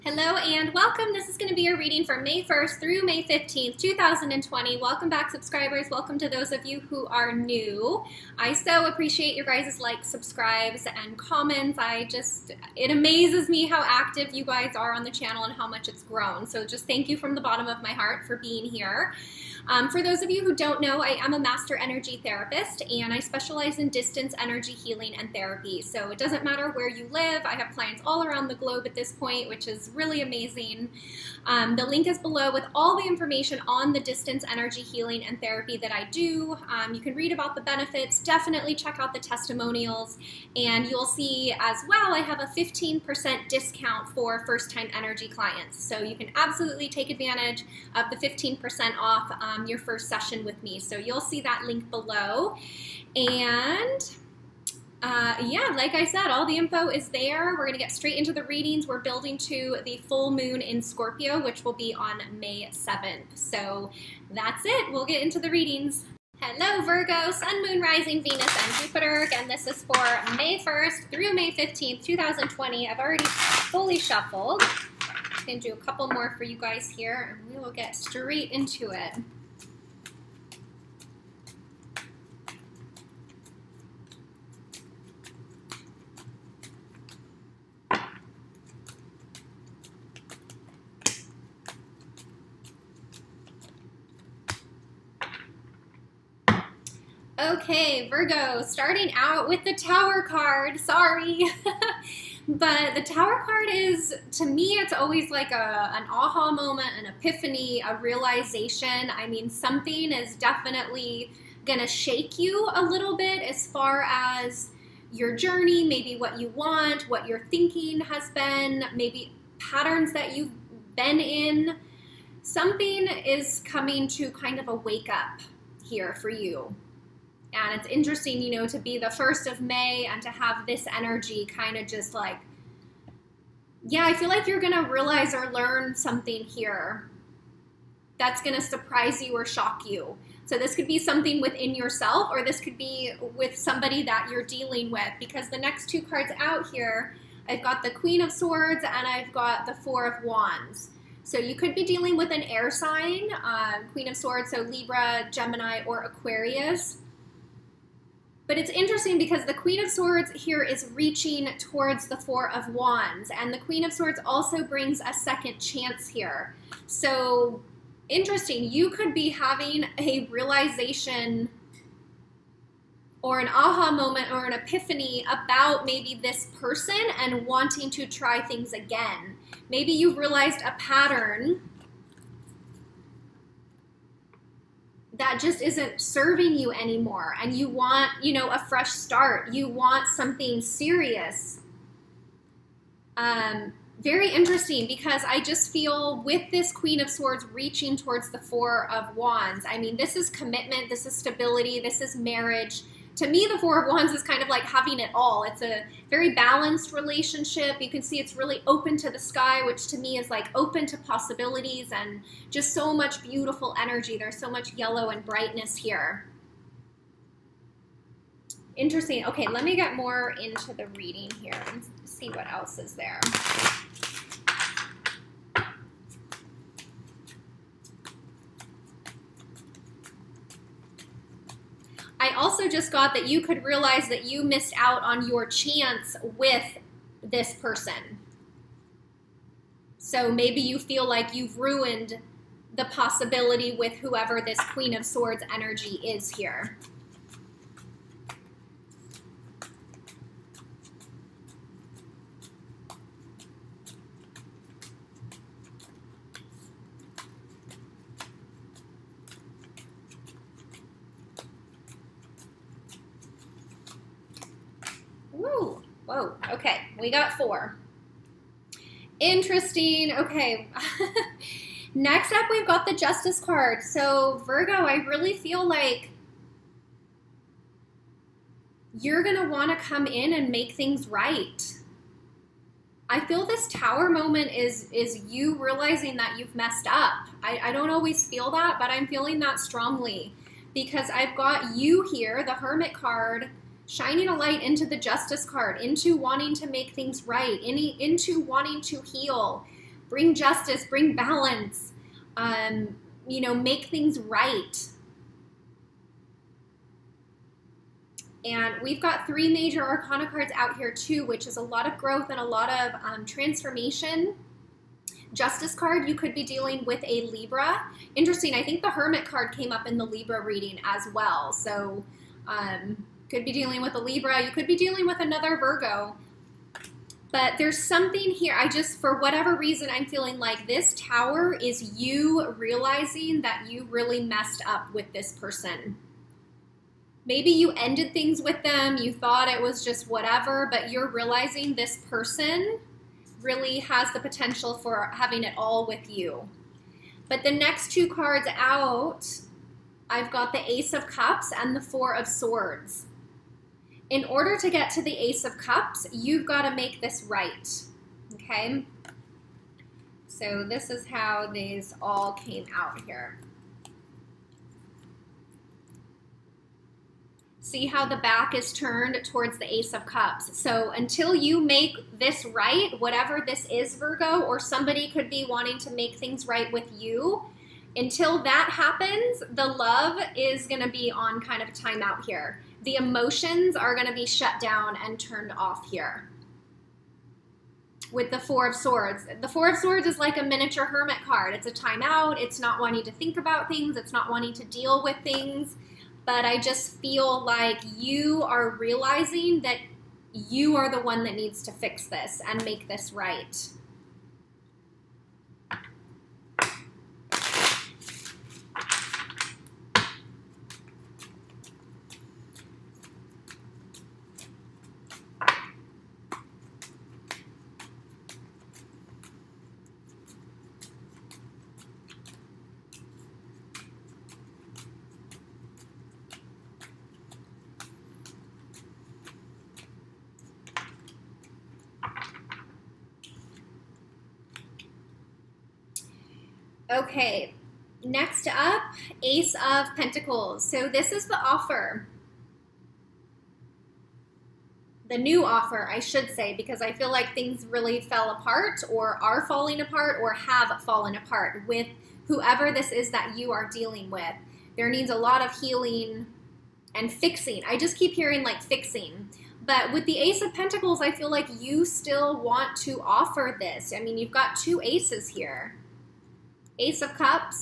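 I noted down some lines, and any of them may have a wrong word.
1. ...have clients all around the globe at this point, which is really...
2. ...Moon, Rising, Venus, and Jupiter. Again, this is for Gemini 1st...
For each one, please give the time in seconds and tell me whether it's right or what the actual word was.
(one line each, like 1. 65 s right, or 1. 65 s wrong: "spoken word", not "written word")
1. 27 s right
2. 67 s wrong: "May", not "Gemini".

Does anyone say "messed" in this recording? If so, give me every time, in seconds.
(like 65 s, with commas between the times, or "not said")
286 s, 334 s.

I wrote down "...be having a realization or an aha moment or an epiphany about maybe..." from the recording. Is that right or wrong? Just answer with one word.
right.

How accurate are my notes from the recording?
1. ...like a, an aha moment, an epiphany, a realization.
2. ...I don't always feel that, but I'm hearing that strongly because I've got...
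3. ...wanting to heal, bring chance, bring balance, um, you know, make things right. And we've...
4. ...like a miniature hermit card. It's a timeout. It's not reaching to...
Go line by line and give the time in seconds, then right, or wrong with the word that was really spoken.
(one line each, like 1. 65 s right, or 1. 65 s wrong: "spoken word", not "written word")
1. 105 s right
2. 287 s wrong: "feeling", not "hearing"
3. 298 s wrong: "justice", not "chance"
4. 390 s wrong: "wanting", not "reaching".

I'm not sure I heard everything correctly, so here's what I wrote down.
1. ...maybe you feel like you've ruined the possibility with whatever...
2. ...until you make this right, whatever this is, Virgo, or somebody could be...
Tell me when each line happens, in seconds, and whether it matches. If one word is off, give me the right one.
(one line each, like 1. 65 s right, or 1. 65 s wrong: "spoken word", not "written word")
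1. 240 s wrong: "whoever", not "whatever"
2. 370 s right.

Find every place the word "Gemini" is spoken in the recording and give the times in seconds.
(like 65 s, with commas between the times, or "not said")
155 s.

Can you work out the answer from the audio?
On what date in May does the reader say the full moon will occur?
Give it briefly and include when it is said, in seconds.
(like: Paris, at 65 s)
May 7th, at 62 s.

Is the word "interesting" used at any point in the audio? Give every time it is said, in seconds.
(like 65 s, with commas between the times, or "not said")
127 s, 158 s, 168 s, 194 s, 218 s, 269 s, 318 s.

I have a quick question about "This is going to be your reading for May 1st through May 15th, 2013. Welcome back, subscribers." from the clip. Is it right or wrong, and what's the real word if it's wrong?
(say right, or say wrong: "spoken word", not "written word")
wrong: "2020", not "2013".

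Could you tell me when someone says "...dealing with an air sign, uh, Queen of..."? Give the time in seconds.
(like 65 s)
151 s.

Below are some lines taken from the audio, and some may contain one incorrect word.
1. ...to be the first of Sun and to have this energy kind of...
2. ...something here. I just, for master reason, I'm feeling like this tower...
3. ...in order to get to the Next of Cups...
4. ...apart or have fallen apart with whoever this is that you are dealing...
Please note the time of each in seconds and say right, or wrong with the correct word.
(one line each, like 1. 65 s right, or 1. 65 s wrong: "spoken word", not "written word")
1. 128 s wrong: "May", not "Sun"
2. 327 s wrong: "whatever", not "master"
3. 354 s wrong: "Ace", not "Next"
4. 449 s right.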